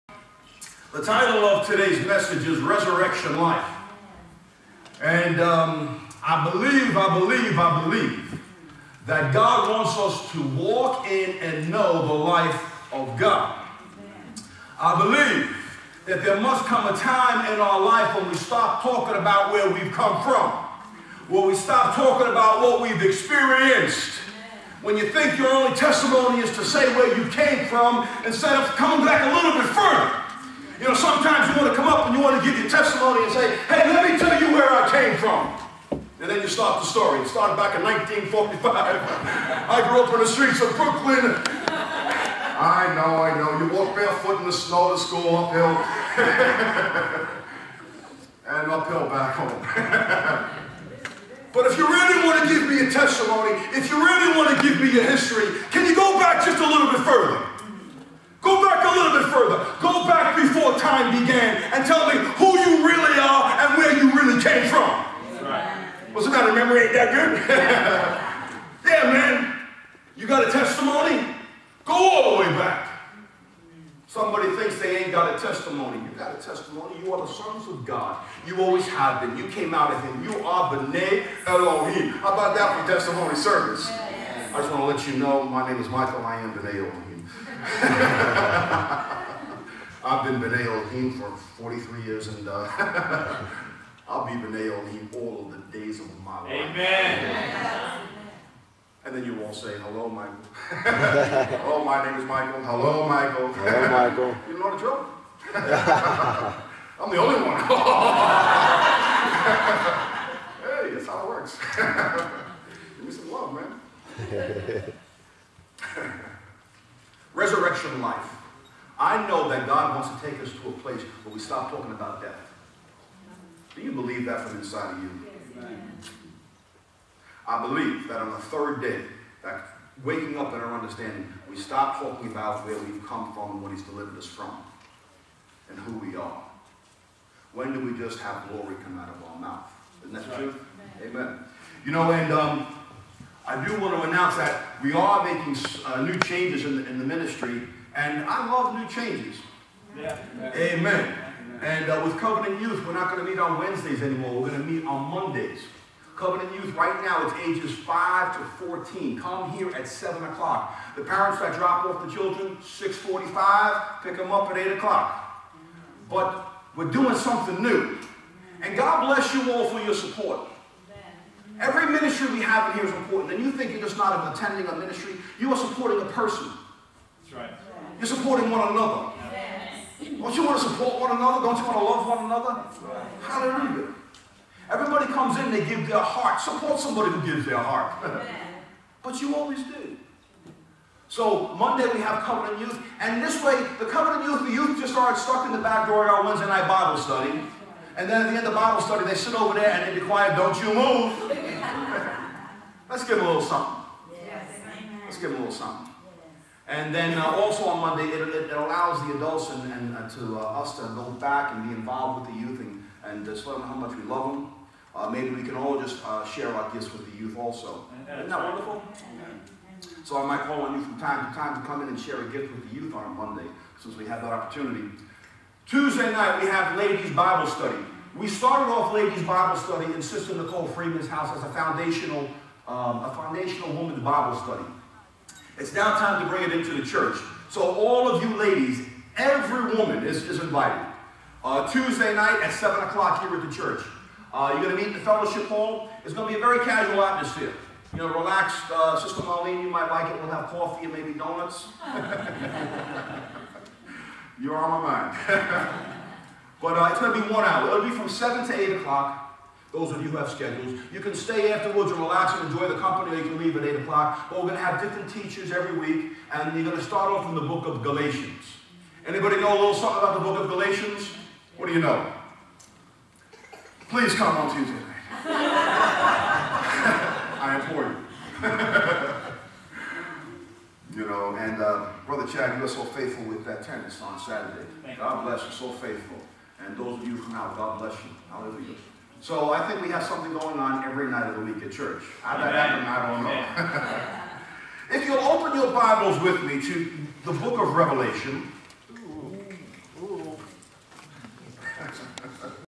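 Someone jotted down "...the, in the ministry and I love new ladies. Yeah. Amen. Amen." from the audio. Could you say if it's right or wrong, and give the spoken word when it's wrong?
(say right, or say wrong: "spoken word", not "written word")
wrong: "changes", not "ladies".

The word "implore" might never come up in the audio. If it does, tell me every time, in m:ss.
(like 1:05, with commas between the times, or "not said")
4:37.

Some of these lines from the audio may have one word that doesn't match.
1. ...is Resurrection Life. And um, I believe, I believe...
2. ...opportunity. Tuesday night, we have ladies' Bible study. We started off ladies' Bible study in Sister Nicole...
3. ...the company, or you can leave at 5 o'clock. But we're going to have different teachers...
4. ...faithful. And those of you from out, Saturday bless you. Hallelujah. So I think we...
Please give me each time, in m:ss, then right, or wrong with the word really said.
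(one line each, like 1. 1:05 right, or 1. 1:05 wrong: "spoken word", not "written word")
1. 0:02 right
2. 3:44 right
3. 4:22 wrong: "8", not "5"
4. 4:45 wrong: "God", not "Saturday".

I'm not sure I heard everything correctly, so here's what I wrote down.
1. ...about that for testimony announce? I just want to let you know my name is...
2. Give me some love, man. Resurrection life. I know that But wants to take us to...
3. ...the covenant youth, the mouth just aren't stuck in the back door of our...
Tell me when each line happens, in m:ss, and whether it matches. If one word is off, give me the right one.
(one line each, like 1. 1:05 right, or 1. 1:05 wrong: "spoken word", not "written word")
1. 1:22 wrong: "service", not "announce"
2. 1:52 wrong: "God", not "But"
3. 3:13 wrong: "youth", not "mouth".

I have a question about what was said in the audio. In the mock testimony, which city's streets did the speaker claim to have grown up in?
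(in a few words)
Brooklyn.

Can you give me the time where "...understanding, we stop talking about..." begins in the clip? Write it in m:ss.
2:10.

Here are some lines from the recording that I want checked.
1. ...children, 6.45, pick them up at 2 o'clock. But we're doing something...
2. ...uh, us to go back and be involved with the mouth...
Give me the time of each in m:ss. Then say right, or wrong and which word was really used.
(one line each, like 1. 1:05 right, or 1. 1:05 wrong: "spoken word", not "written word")
1. 2:42 wrong: "8", not "2"
2. 3:30 wrong: "youth", not "mouth".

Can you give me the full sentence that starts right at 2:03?
Do you believe that from inside of you?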